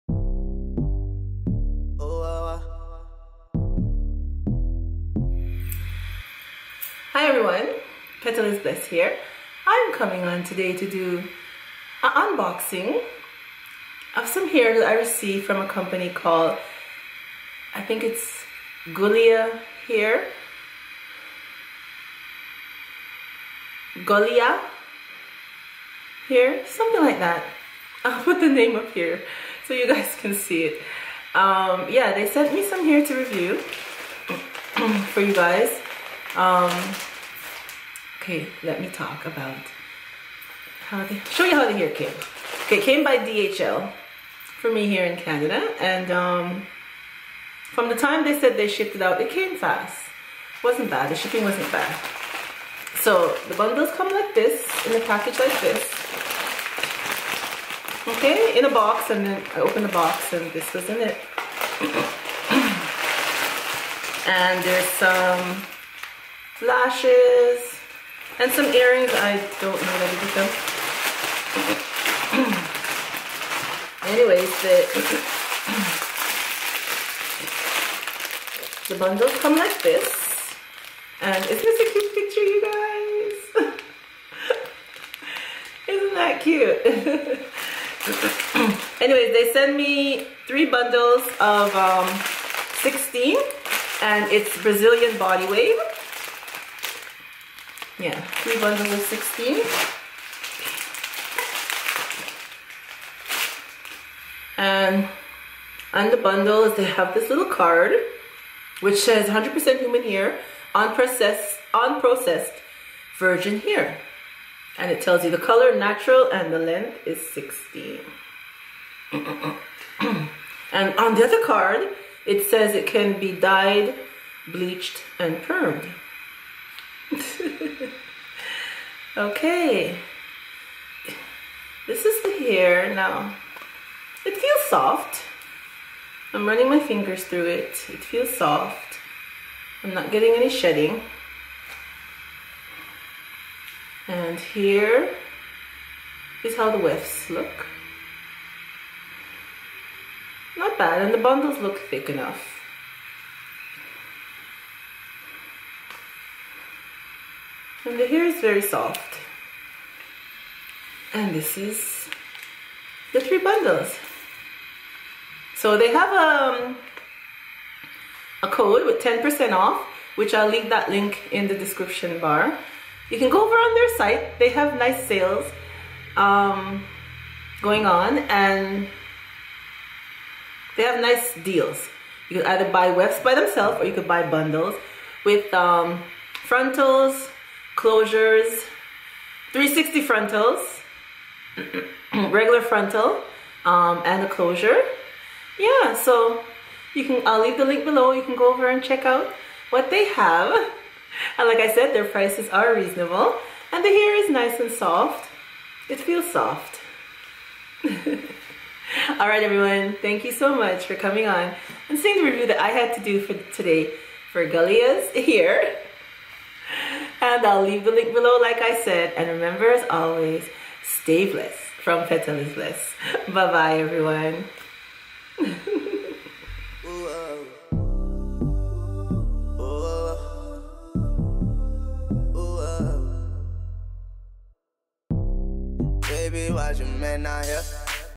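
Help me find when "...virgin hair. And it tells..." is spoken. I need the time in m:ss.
1:53.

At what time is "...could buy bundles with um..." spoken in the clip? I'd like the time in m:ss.
3:03.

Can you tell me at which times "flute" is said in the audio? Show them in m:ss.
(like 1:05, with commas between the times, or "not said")
not said.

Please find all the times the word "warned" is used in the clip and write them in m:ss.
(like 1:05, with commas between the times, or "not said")
not said.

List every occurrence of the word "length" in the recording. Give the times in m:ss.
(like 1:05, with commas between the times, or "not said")
1:56.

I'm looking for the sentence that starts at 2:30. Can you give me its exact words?
Not bad, and the bundles look thick enough.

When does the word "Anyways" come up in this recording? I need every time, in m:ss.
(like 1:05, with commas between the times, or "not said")
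1:14, 1:29.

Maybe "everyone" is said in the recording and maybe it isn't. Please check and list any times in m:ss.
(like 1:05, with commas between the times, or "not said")
0:07, 3:29, 3:43.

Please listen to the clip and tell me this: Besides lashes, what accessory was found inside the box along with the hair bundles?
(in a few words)
Earrings.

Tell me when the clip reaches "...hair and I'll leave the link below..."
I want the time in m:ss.
3:35.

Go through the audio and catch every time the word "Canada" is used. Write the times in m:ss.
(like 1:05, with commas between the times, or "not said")
0:45.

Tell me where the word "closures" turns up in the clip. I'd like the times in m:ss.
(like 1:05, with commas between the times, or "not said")
3:07, 3:14.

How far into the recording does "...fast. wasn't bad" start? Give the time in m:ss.
0:49.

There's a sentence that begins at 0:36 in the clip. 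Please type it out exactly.
Um, Okay, let me talk about how they show you how the hair came.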